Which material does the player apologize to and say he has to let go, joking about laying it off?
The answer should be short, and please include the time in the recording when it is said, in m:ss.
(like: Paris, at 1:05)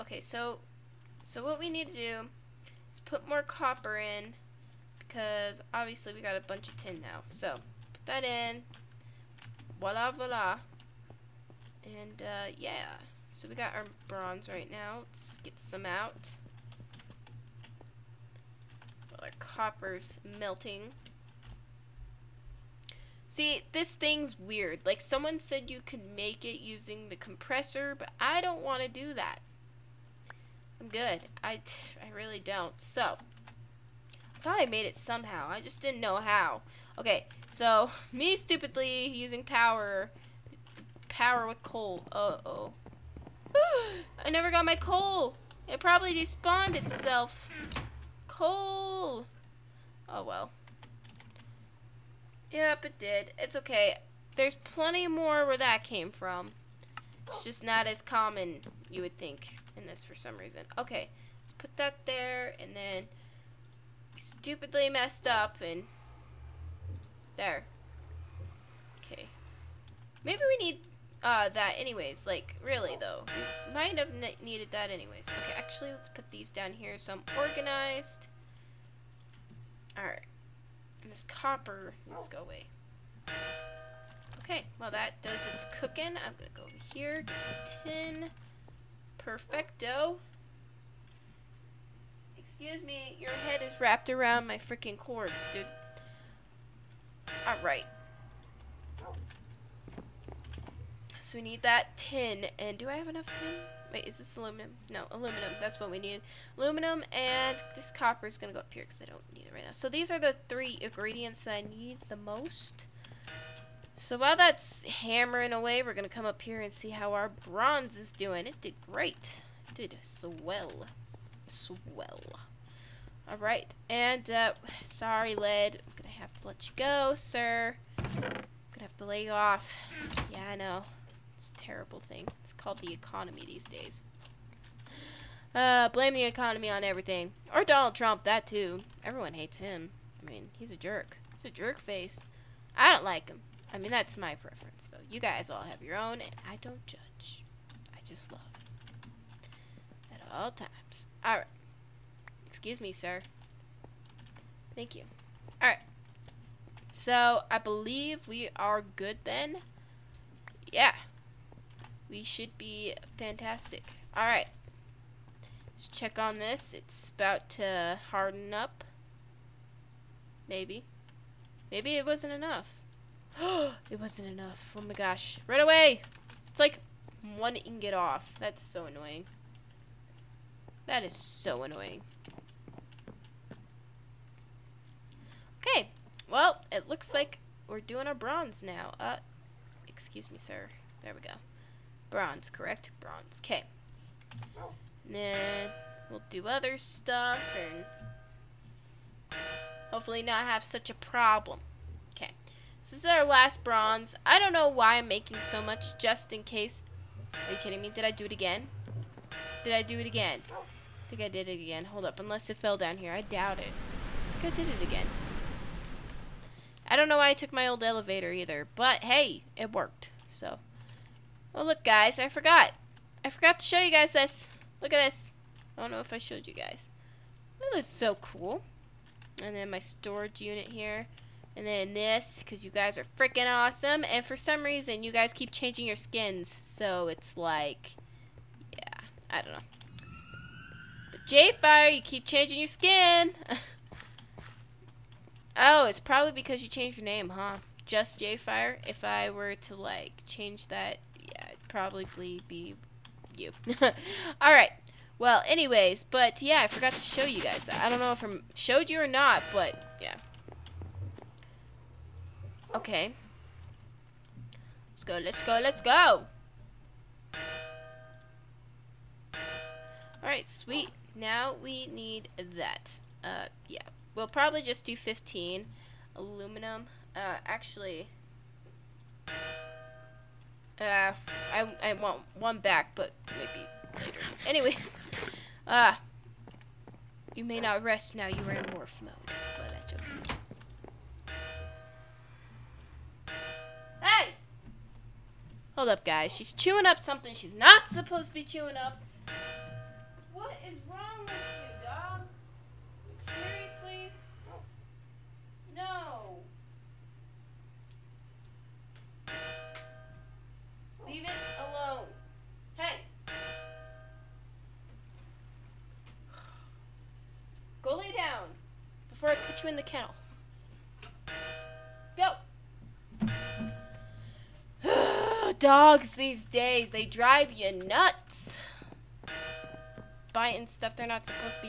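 Lead, at 2:05.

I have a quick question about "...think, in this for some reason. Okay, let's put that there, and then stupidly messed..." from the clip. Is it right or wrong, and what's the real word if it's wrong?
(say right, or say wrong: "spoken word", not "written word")
right.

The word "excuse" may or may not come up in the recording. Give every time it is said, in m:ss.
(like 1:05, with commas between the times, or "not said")
1:32, 2:32, 3:09.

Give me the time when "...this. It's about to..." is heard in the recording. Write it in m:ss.
2:46.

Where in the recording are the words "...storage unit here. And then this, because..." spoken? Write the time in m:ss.
3:49.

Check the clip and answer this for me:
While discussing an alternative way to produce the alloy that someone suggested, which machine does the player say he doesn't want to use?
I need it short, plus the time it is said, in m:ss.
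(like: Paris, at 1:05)
compressor, at 0:27.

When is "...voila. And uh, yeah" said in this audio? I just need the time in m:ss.
0:10.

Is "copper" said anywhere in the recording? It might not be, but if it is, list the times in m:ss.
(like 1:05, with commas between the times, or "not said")
0:03, 0:19, 1:21, 1:47.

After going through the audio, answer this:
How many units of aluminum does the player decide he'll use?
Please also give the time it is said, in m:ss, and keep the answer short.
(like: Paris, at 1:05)
15, at 4:34.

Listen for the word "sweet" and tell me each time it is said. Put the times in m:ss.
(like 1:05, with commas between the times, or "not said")
4:30.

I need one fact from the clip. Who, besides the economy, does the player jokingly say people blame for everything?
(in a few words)
Donald Trump.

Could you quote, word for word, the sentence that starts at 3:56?
So it's like, yeah, I don't know.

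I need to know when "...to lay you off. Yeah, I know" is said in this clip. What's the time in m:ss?
2:08.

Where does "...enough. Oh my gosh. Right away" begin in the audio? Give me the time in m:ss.
2:54.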